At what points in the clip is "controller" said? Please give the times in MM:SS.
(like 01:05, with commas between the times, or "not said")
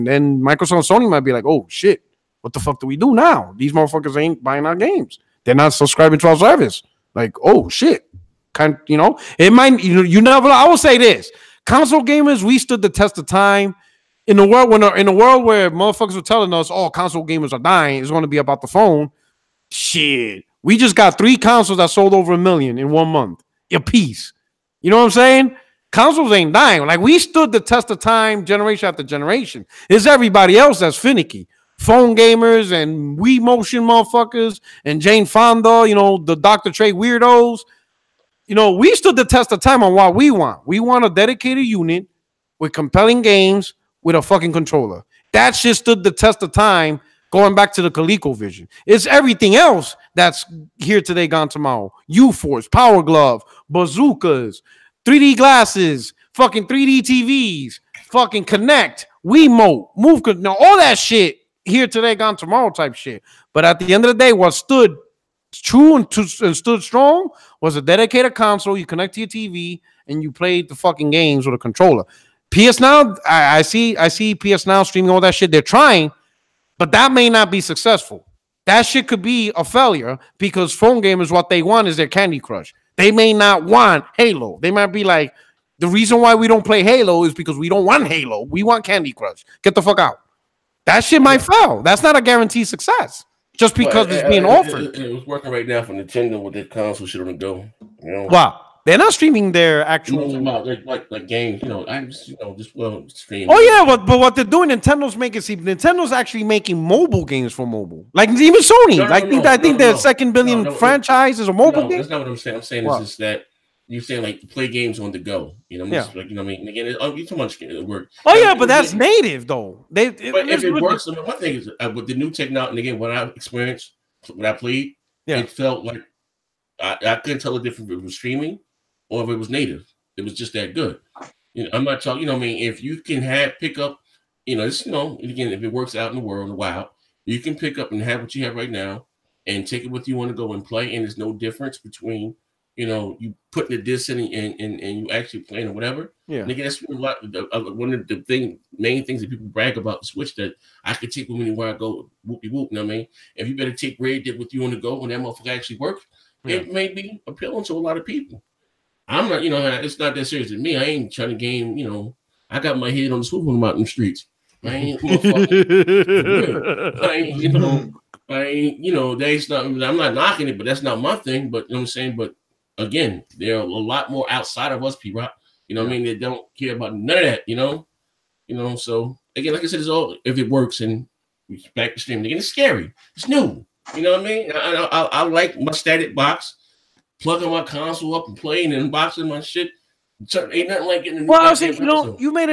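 00:44, 01:11.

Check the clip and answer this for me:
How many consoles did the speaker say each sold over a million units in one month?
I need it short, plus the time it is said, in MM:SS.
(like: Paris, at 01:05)
3, at 00:21.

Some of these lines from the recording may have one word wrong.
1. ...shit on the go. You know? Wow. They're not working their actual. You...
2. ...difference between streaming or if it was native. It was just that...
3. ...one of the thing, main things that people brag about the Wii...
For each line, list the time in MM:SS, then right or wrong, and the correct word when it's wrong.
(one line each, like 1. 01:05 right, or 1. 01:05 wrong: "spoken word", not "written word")
1. 01:37 wrong: "streaming", not "working"
2. 02:07 right
3. 02:27 wrong: "Switch", not "Wii".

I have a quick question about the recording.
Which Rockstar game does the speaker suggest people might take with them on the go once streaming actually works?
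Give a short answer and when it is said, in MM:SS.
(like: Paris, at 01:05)
Red Dead, at 02:33.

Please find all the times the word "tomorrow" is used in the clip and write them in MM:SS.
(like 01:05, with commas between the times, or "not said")
00:51, 01:02.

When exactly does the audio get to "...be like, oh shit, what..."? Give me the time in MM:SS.
00:01.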